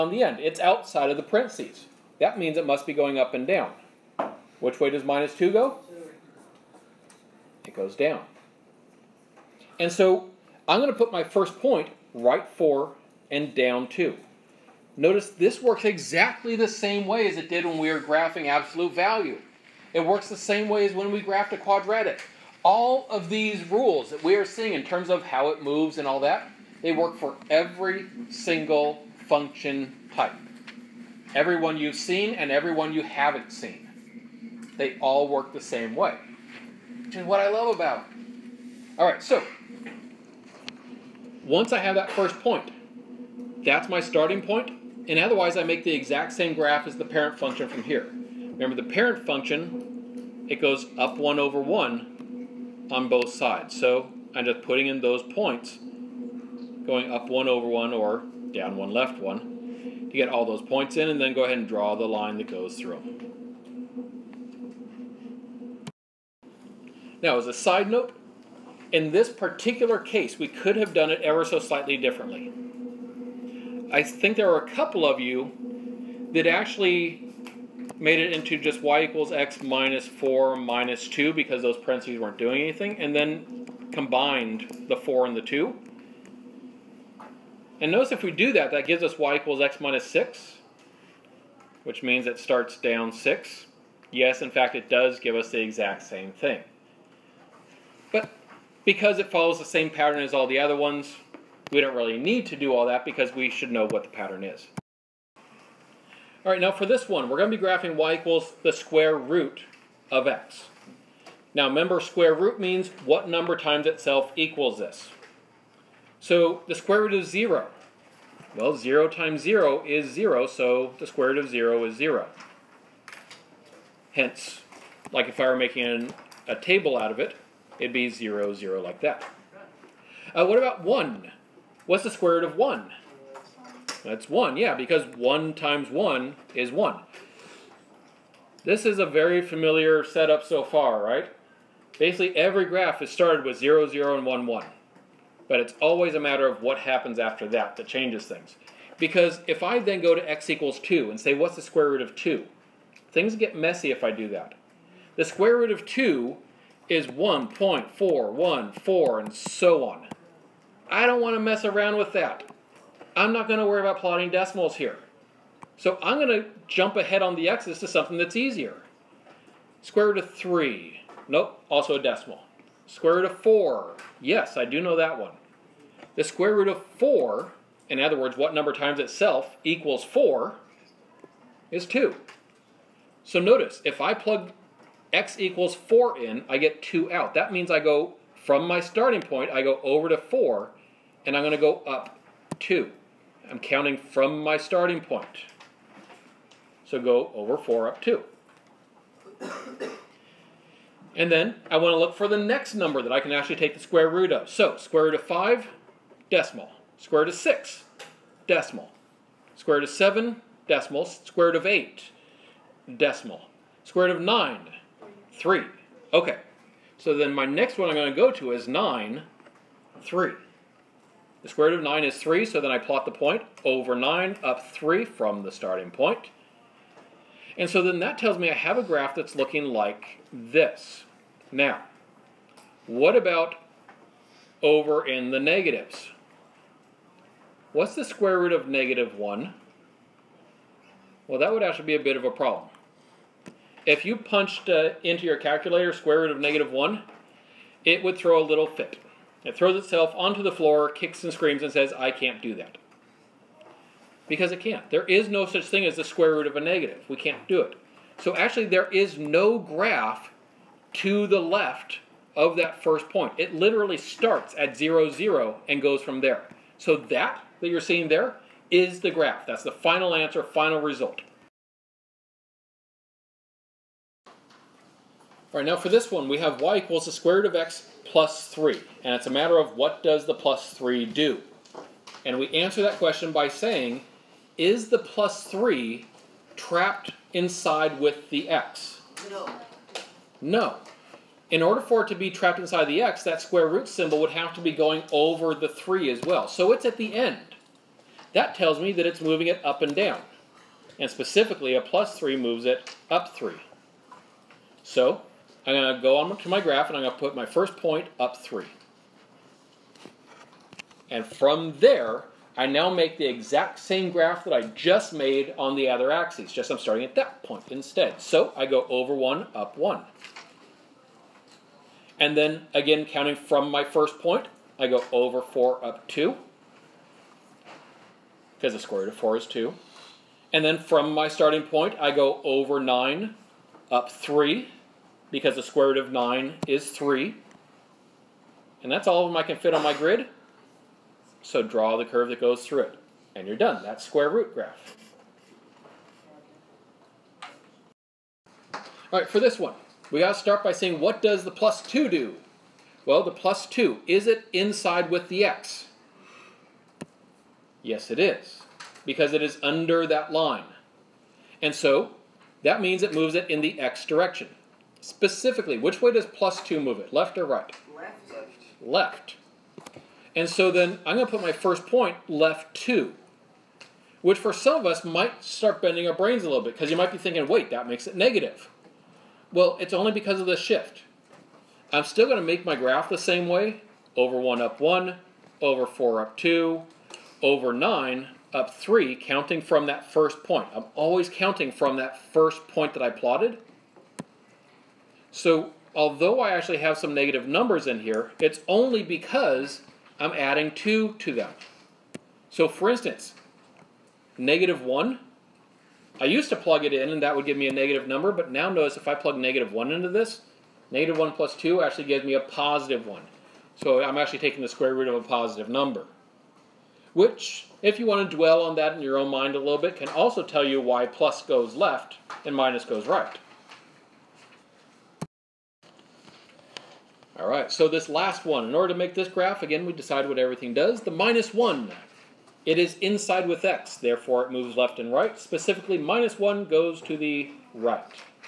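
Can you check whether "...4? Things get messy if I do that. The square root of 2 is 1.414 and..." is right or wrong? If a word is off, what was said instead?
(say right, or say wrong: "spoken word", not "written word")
wrong: "2", not "4".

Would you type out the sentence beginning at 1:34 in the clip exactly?
Yes, in fact, it does give us the exact same thing.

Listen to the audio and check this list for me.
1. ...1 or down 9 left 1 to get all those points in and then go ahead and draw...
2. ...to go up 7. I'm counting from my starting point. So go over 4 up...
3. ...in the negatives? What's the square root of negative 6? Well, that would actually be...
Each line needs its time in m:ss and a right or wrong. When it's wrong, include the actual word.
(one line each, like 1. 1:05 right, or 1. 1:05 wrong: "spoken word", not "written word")
1. 0:57 wrong: "1", not "9"
2. 3:11 wrong: "2", not "7"
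3. 3:55 wrong: "1", not "6".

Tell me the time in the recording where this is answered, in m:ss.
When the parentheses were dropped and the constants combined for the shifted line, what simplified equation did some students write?
1:29.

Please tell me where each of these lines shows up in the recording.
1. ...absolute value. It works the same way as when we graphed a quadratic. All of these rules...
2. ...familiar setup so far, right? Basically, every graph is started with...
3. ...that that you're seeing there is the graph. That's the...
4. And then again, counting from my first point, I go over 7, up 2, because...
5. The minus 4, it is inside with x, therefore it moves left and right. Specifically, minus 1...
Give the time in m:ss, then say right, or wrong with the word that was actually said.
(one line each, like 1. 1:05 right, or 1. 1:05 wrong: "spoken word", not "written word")
1. 0:18 right
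2. 2:19 right
3. 4:26 right
4. 5:22 wrong: "4", not "7"
5. 7:11 wrong: "1", not "4".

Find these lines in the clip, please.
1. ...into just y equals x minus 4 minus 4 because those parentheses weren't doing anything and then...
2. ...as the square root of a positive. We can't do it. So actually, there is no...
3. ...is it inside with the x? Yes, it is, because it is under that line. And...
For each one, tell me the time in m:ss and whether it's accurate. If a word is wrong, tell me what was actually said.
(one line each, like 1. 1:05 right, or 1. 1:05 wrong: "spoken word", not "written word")
1. 1:18 wrong: "2", not "4"
2. 4:15 wrong: "negative", not "positive"
3. 5:54 right.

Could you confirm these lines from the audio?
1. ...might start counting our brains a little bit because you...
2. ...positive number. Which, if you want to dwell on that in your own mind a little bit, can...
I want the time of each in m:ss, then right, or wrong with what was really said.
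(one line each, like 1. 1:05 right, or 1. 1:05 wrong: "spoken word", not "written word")
1. 6:15 wrong: "bending", not "counting"
2. 6:55 right.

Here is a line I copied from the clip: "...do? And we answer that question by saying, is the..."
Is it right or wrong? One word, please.
right.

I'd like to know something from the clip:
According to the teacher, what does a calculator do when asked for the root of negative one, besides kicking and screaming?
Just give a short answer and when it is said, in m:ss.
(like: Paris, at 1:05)
Throws itself onto the floor, at 4:09.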